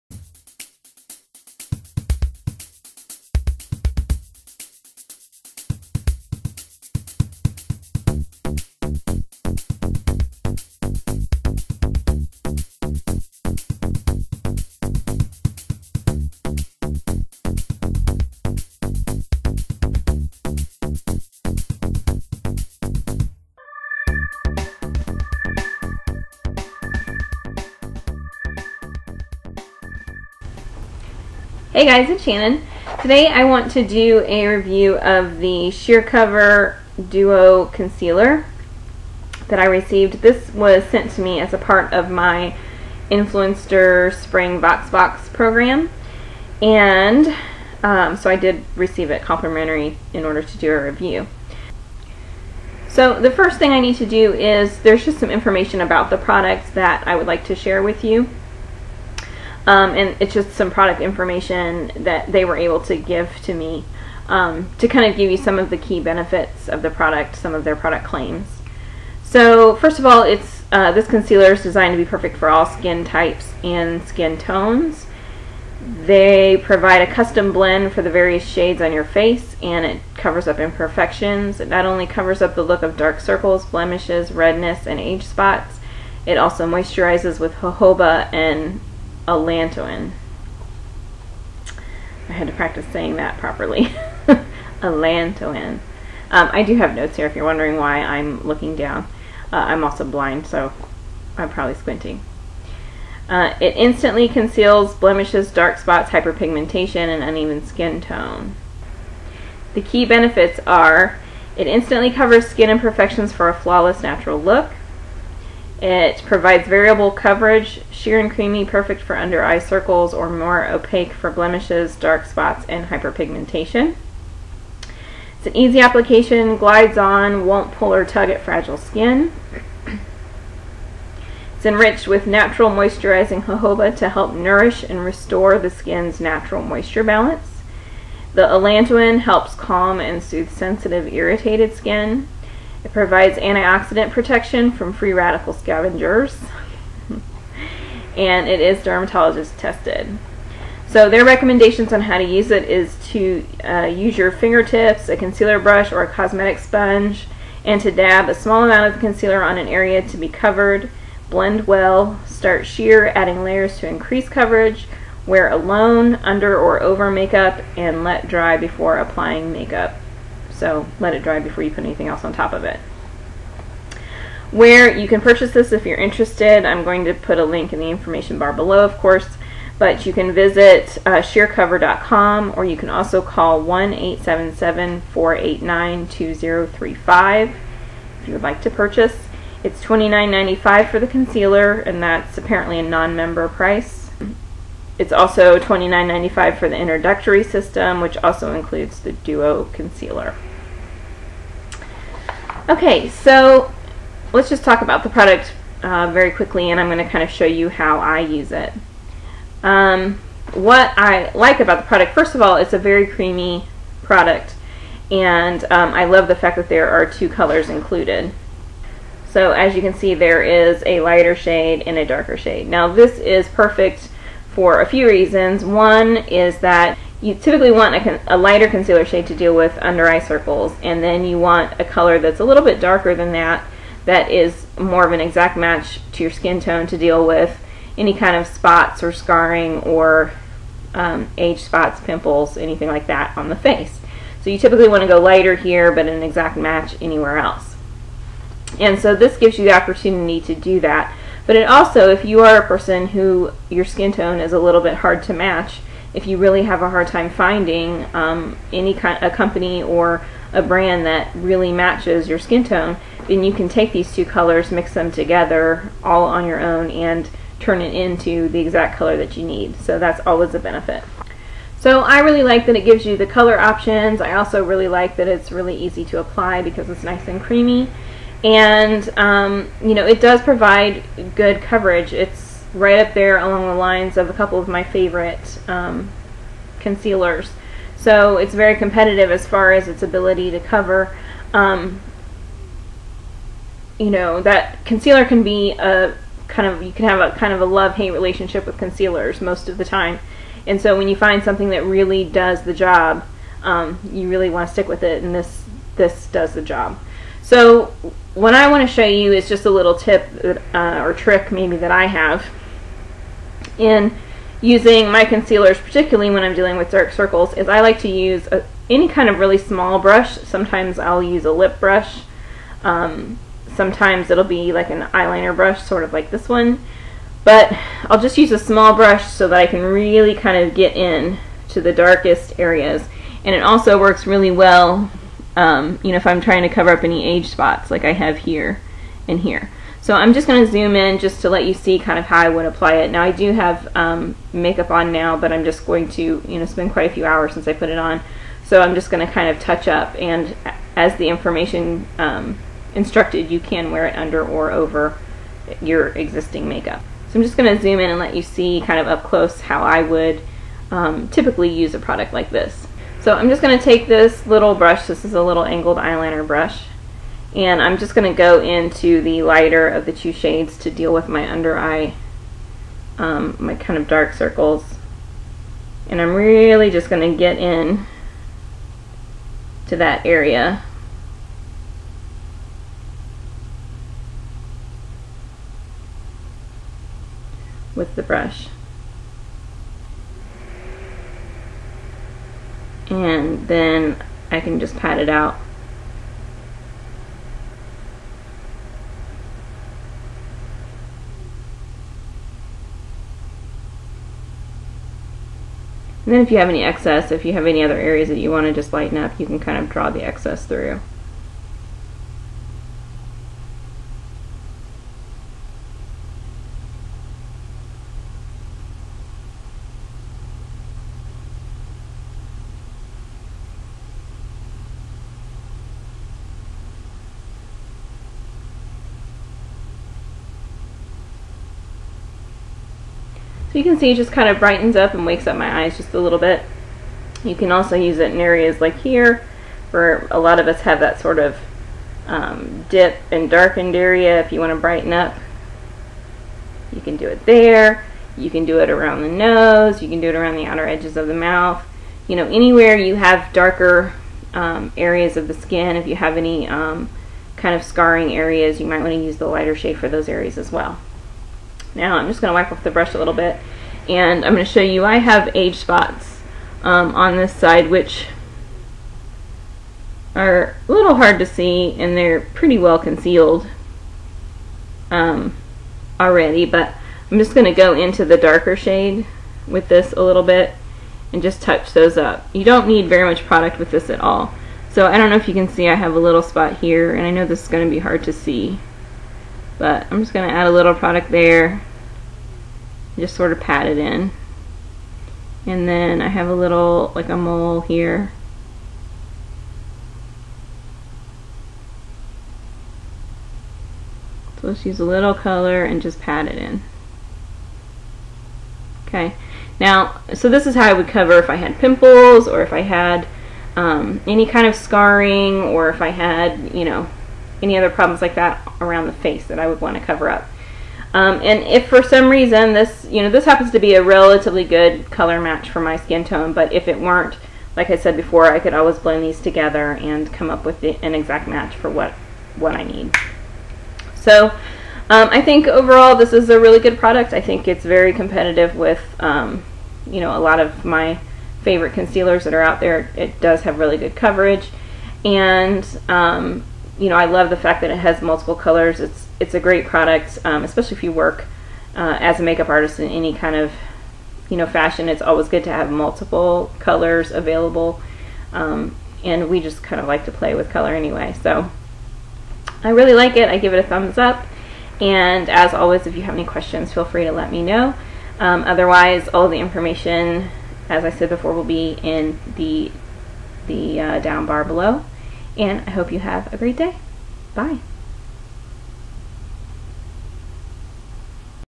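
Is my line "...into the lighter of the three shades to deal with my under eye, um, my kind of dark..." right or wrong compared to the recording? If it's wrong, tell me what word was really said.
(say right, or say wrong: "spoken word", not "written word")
wrong: "two", not "three".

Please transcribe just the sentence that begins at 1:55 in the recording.
It provides variable coverage, sheer and creamy, perfect for under eye circles or more opaque for blemishes, dark spots, and hyperpigmentation.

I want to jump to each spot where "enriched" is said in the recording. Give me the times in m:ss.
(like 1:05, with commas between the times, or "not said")
2:11.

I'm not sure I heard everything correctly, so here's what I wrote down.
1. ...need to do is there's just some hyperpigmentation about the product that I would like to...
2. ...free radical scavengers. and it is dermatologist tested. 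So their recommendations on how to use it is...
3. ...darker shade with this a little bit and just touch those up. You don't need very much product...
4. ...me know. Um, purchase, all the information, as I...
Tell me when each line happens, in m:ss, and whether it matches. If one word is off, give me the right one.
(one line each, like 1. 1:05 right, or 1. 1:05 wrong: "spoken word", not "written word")
1. 0:53 wrong: "information", not "hyperpigmentation"
2. 2:24 right
3. 7:58 right
4. 9:27 wrong: "otherwise", not "purchase".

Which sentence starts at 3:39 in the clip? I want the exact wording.
So as you can see there is a lighter shade and a darker shade.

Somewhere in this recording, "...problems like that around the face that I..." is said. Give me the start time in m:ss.
8:37.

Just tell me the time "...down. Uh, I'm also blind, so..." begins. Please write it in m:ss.
1:38.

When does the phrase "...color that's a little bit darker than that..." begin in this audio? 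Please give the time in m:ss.
3:51.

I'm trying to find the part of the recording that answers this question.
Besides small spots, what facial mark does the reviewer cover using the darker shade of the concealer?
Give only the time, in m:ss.
8:17.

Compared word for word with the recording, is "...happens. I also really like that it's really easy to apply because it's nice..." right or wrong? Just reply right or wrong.
wrong.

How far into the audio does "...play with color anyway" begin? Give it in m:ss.
9:20.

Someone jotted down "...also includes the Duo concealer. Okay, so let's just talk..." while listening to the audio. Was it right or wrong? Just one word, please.
right.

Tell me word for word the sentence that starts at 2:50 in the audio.
So let it dry before you put anything else on top of it.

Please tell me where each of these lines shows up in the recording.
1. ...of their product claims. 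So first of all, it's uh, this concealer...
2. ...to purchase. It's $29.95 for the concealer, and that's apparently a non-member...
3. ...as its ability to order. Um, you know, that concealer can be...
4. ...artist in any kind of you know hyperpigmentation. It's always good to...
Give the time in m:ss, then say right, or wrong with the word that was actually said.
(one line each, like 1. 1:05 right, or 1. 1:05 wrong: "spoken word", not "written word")
1. 1:07 right
2. 3:08 right
3. 4:49 wrong: "cover", not "order"
4. 9:12 wrong: "fashion", not "hyperpigmentation".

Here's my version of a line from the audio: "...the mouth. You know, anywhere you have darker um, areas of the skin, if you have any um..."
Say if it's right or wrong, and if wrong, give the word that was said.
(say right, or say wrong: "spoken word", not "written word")
right.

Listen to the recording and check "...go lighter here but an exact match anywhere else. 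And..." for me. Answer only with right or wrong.
right.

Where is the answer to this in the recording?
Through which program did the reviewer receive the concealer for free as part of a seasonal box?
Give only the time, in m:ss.
0:43.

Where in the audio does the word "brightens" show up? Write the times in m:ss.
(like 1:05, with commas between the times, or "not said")
7:14, 7:24.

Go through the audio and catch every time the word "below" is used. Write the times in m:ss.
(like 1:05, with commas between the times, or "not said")
2:58, 9:34.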